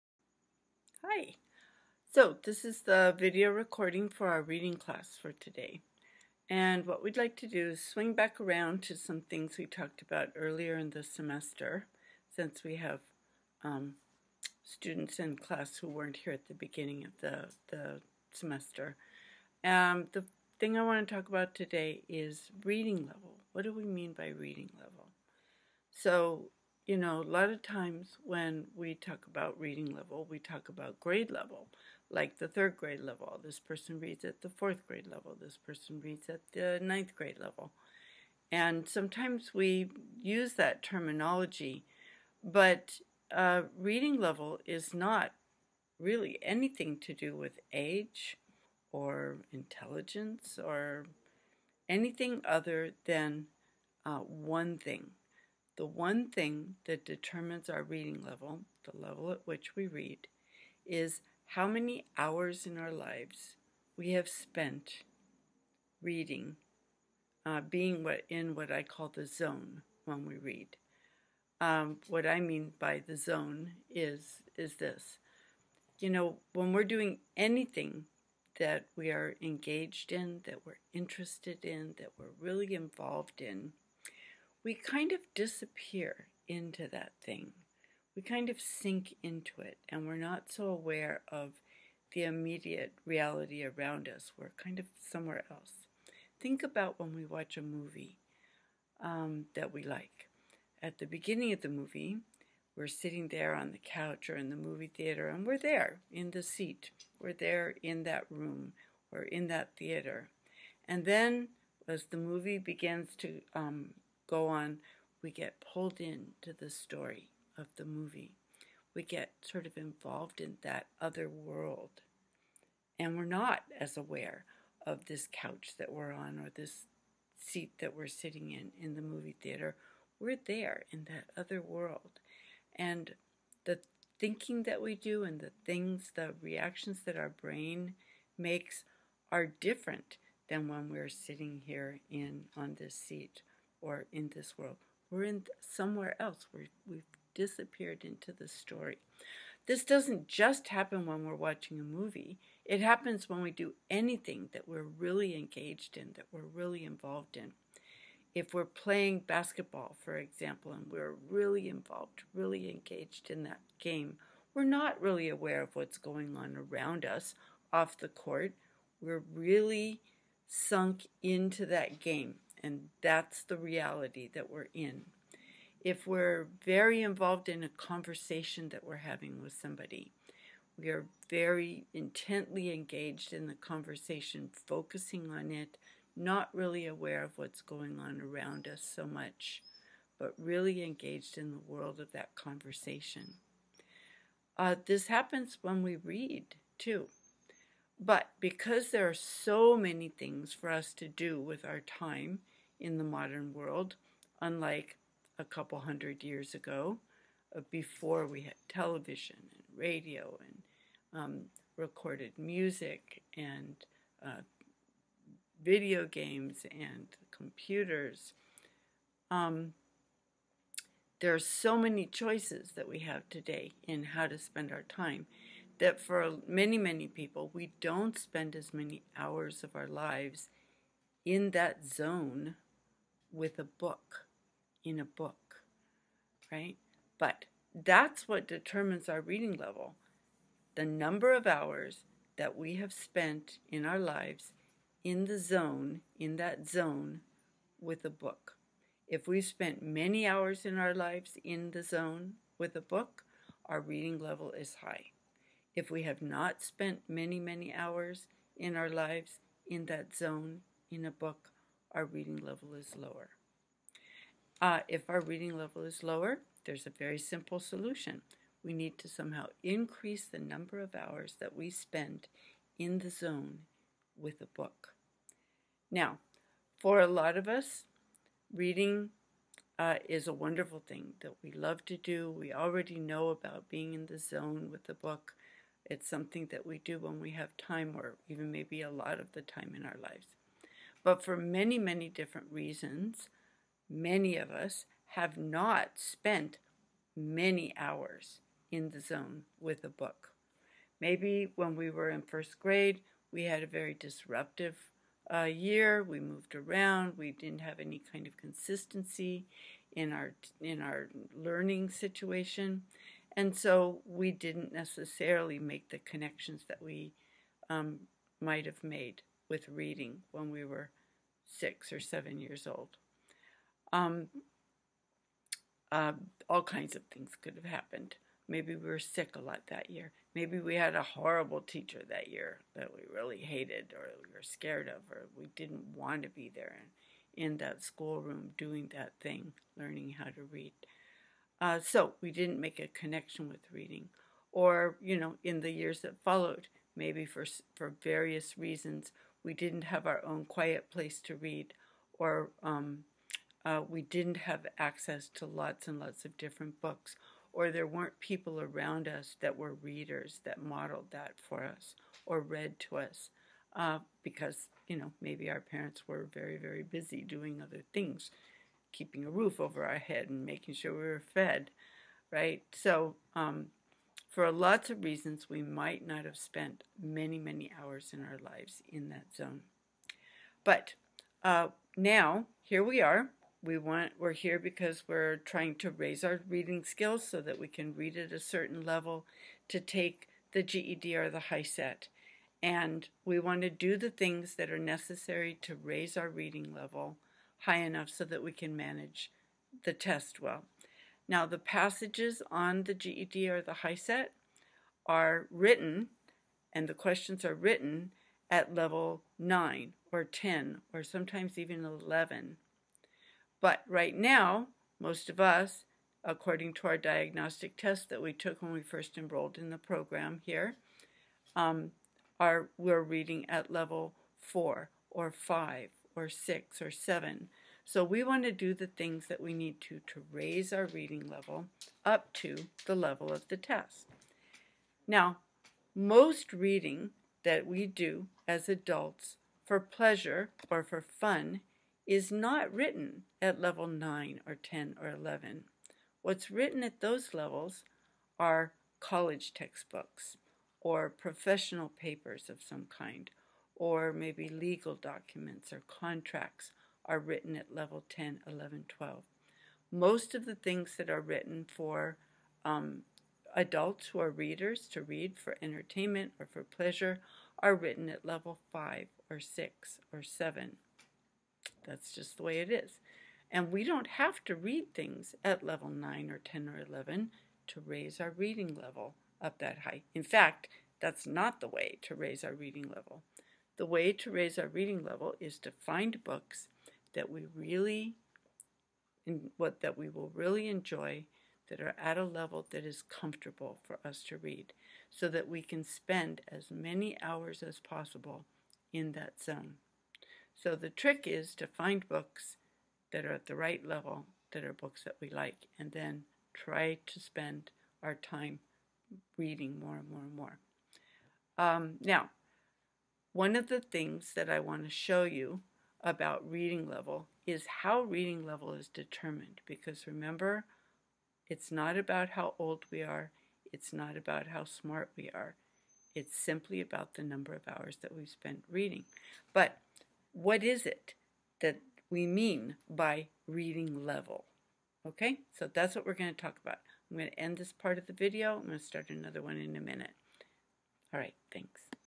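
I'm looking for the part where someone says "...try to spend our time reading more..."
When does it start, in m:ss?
8:26.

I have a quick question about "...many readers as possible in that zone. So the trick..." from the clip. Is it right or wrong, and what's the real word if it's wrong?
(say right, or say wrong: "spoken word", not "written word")
wrong: "hours", not "readers".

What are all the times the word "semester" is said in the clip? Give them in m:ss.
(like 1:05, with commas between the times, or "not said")
0:11, 0:18.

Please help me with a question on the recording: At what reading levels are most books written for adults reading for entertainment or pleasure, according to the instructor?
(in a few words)
5, 6 or 7.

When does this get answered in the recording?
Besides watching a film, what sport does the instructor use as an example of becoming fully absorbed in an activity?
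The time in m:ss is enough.
2:39.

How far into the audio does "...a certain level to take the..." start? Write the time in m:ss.
6:28.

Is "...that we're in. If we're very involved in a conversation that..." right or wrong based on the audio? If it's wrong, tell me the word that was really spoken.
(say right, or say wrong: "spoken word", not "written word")
right.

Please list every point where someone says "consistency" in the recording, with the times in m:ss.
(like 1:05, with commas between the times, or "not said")
5:08.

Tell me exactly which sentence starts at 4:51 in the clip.
But for many, many different reasons, many of us have not spent many hours in the zone with a book.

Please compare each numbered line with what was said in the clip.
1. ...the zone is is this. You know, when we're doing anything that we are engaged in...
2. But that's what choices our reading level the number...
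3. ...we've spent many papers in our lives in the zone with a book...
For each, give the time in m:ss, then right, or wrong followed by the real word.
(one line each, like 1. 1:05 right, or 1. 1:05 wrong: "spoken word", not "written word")
1. 1:13 right
2. 3:57 wrong: "determines", not "choices"
3. 4:09 wrong: "hours", not "papers".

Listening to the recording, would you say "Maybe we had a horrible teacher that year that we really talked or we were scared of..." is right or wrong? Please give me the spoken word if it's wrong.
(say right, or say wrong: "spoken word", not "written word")
wrong: "hated", not "talked".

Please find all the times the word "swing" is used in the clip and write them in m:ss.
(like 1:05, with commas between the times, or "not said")
0:07.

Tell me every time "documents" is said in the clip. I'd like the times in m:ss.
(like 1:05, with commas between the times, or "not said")
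7:34.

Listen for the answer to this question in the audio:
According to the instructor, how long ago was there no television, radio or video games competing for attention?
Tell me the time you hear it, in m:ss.
3:25.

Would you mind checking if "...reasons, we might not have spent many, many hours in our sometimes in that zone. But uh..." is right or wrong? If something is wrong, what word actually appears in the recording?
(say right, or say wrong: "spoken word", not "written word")
wrong: "lives", not "sometimes".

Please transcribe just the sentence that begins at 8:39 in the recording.
Because remember, it's not about how old we are, it's not about how smart we are.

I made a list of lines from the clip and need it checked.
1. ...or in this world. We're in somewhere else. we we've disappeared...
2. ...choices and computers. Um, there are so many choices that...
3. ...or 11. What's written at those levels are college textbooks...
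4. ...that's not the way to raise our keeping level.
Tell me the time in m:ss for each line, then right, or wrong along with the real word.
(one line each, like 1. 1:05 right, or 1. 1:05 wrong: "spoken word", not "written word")
1. 2:23 right
2. 3:36 wrong: "games", not "choices"
3. 7:25 right
4. 8:01 wrong: "reading", not "keeping".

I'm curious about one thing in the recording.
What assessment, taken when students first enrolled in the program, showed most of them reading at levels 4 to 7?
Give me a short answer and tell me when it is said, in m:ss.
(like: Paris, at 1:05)
Diagnostic test, at 6:56.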